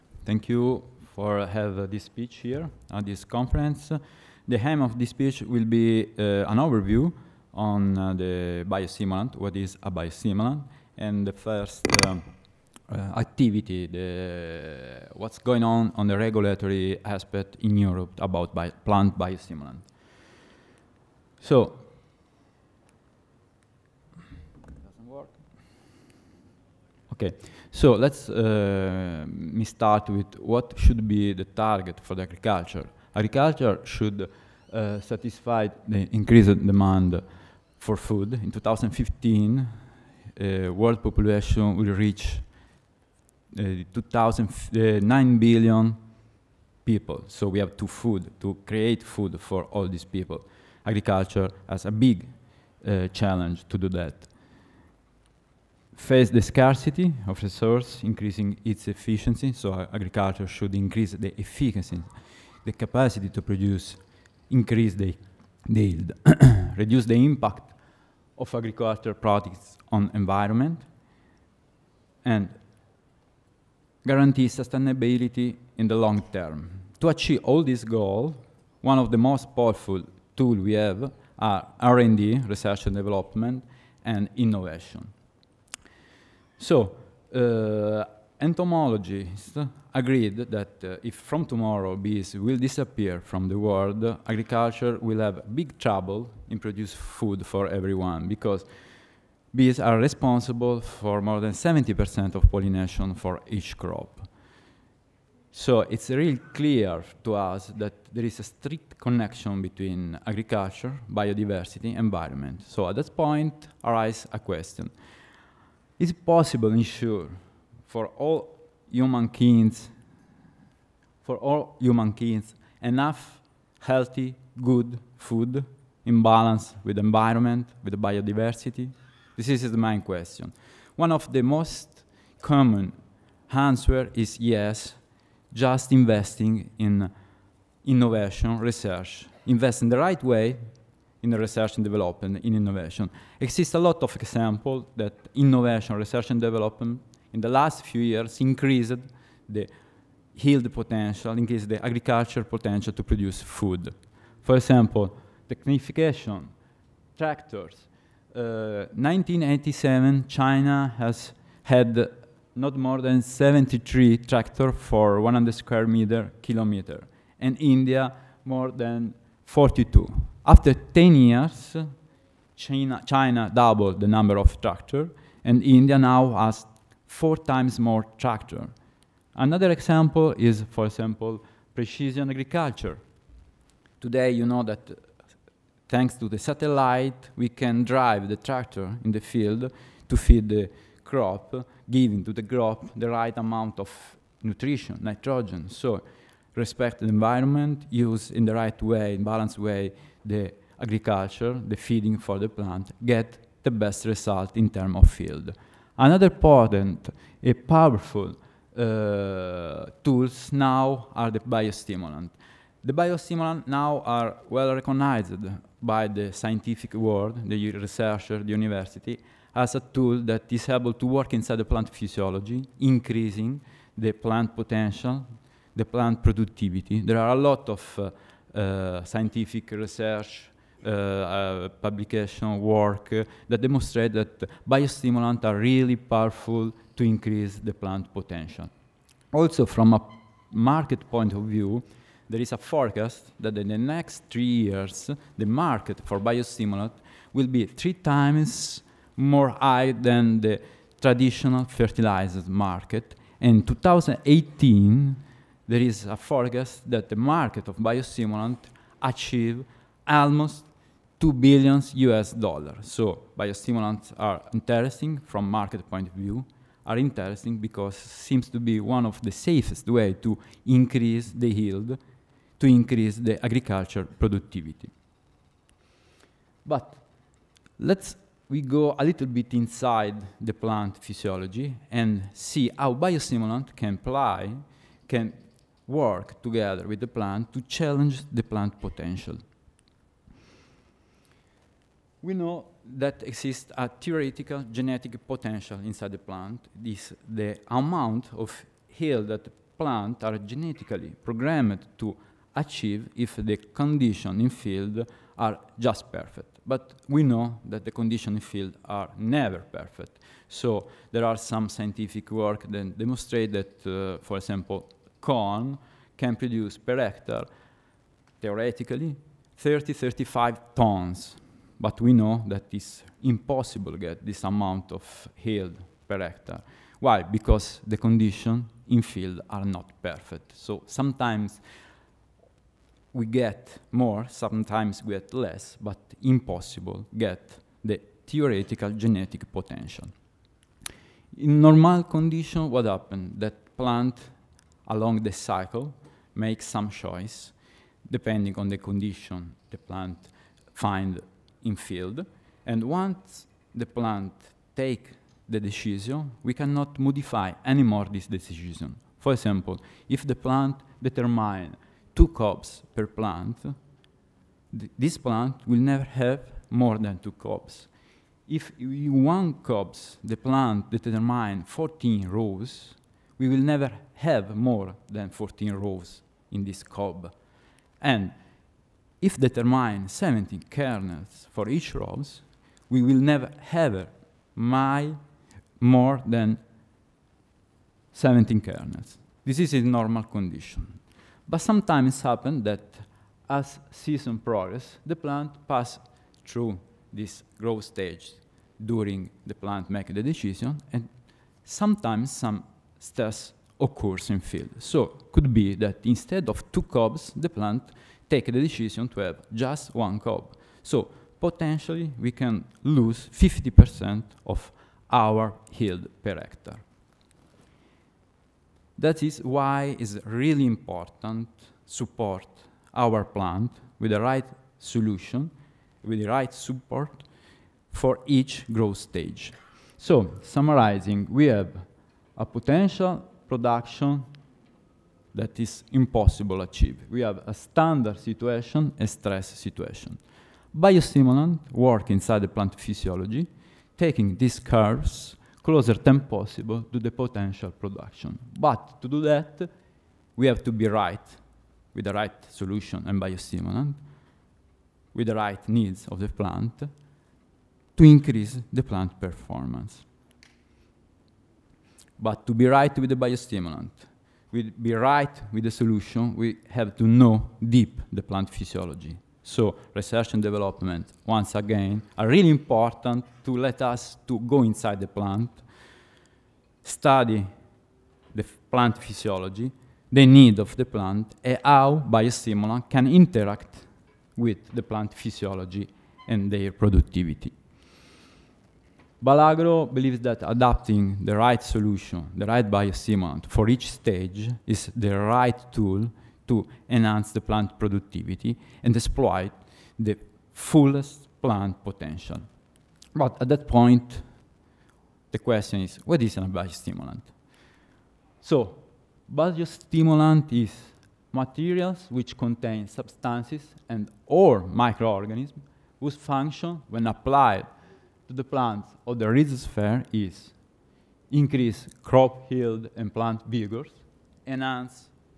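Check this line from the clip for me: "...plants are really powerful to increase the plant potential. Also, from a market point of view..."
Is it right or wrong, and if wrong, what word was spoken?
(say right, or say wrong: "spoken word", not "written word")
wrong: "biostimulants", not "plants".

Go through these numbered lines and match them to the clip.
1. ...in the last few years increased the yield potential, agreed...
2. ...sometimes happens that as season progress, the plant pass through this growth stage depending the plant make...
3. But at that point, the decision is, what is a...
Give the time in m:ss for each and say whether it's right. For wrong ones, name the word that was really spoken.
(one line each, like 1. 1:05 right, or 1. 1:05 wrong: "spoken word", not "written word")
1. 2:27 wrong: "increased", not "agreed"
2. 6:31 wrong: "during", not "depending"
3. 8:23 wrong: "question", not "decision".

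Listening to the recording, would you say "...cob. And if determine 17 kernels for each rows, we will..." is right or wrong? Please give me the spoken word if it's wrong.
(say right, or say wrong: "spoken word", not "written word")
right.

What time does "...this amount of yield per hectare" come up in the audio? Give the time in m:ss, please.
5:24.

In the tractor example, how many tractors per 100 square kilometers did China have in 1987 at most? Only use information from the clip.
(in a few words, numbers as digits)
73.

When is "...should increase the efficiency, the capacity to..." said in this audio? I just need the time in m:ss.
1:00.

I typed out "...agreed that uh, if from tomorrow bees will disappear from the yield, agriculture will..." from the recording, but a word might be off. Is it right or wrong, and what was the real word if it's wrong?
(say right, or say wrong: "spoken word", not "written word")
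wrong: "world", not "yield".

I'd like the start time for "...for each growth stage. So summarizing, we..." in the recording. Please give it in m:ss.
7:07.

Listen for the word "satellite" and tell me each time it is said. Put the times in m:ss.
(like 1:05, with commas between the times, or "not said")
3:06.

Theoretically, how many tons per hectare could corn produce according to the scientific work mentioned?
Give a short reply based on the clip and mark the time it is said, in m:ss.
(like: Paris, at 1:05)
30 to 35 tons, at 5:19.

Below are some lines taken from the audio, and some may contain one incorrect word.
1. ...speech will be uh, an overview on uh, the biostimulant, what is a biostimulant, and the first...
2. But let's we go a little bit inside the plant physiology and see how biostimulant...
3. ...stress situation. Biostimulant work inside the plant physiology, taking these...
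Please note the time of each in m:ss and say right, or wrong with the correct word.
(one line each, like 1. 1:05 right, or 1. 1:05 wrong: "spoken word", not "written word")
1. 0:05 right
2. 4:36 right
3. 7:19 right.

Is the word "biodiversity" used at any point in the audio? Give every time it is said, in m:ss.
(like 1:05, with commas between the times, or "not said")
1:51, 2:07.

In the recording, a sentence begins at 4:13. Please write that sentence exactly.
In 2018 there is a forecast that the market of biostimulant achieve almost 2 billion US dollars.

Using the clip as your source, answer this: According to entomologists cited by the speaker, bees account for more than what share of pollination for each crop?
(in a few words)
70%.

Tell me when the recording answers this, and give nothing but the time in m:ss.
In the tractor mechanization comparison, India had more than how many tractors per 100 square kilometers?
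2:49.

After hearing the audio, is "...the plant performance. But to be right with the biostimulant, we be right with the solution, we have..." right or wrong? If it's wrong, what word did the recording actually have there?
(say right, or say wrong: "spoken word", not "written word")
right.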